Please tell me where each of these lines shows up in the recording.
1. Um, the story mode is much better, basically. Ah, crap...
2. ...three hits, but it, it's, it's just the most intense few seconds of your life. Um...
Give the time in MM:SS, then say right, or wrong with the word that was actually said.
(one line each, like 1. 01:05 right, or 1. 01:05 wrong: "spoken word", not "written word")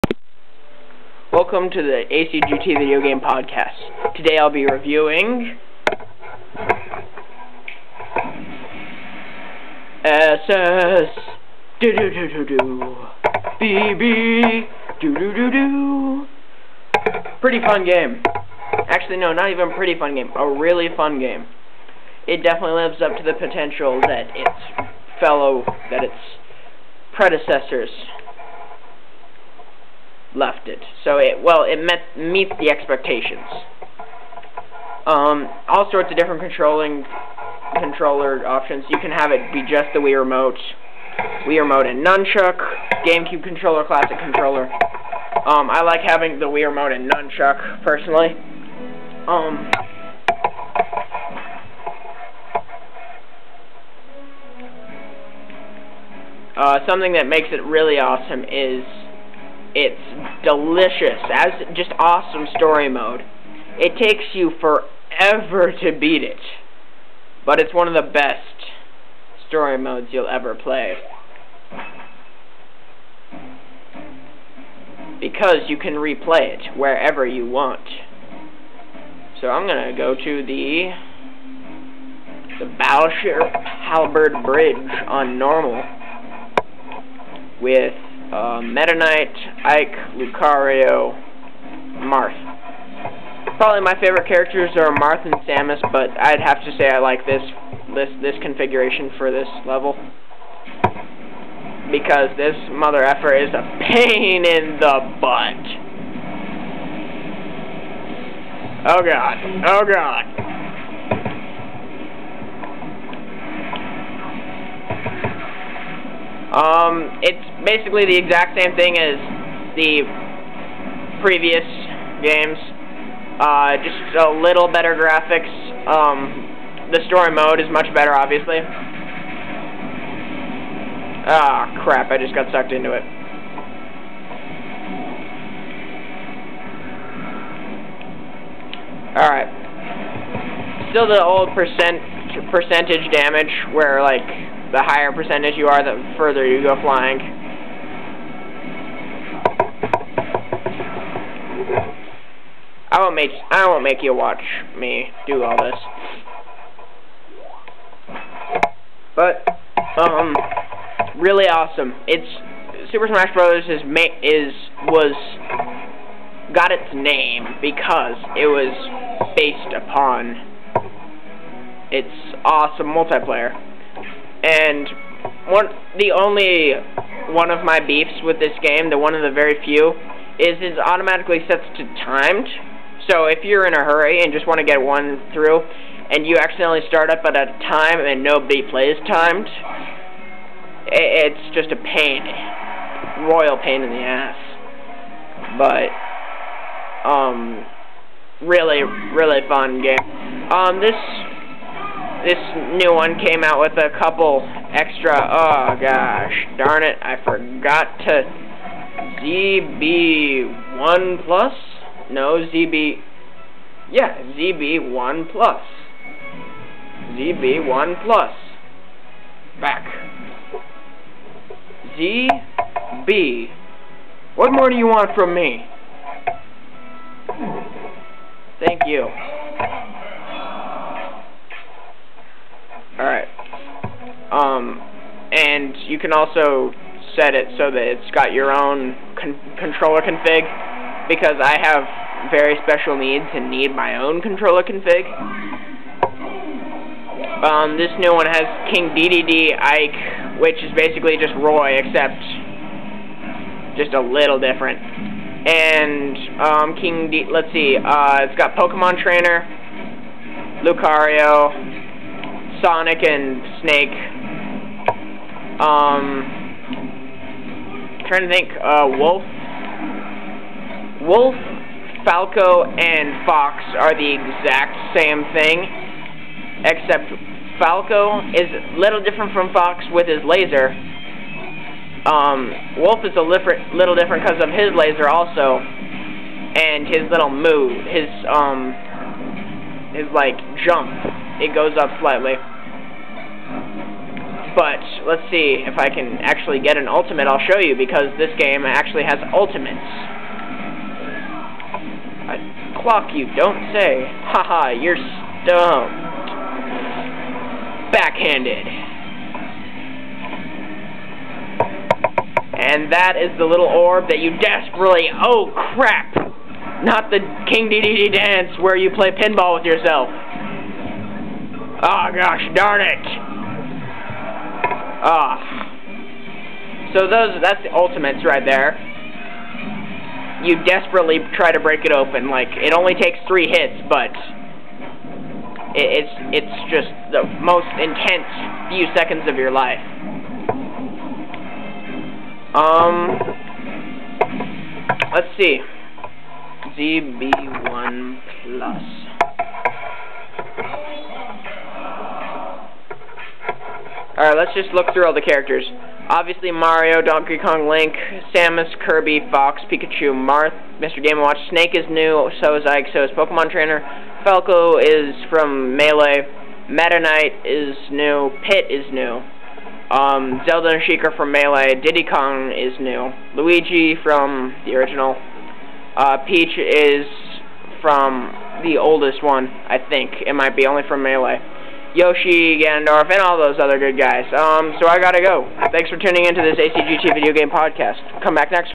1. 02:05 wrong: "obviously", not "basically"
2. 05:33 right.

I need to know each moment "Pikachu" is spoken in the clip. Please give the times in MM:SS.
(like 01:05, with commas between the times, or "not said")
05:59.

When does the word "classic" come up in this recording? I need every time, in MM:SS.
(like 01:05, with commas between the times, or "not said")
00:43.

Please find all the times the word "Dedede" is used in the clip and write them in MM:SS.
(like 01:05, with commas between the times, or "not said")
04:08, 05:17.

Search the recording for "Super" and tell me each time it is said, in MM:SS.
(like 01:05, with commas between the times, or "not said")
02:42.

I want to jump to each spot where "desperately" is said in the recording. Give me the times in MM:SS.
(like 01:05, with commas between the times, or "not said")
05:14, 05:30.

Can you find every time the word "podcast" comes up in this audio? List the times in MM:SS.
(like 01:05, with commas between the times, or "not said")
00:03, 06:27.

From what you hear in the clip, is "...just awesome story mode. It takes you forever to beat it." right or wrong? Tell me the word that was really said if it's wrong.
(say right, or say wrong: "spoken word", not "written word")
right.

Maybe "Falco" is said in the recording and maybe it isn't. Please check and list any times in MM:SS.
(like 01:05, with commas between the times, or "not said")
04:32, 04:37, 06:04.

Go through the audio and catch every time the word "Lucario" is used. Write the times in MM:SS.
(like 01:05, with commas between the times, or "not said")
01:30, 04:20.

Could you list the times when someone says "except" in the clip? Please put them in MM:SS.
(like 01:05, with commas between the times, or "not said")
04:11, 04:36.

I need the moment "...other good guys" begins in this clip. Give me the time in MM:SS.
06:23.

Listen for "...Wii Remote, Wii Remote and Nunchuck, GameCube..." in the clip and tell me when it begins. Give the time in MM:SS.
00:39.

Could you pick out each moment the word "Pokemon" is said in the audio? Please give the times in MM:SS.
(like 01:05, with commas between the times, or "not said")
04:18, 06:03.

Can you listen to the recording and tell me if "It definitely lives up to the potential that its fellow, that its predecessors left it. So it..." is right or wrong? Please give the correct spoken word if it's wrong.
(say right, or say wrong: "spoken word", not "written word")
right.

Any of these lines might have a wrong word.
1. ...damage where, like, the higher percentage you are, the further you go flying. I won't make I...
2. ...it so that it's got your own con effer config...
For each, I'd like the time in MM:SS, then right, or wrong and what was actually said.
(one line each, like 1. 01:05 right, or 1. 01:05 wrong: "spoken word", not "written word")
1. 02:23 right
2. 03:57 wrong: "controller", not "effer".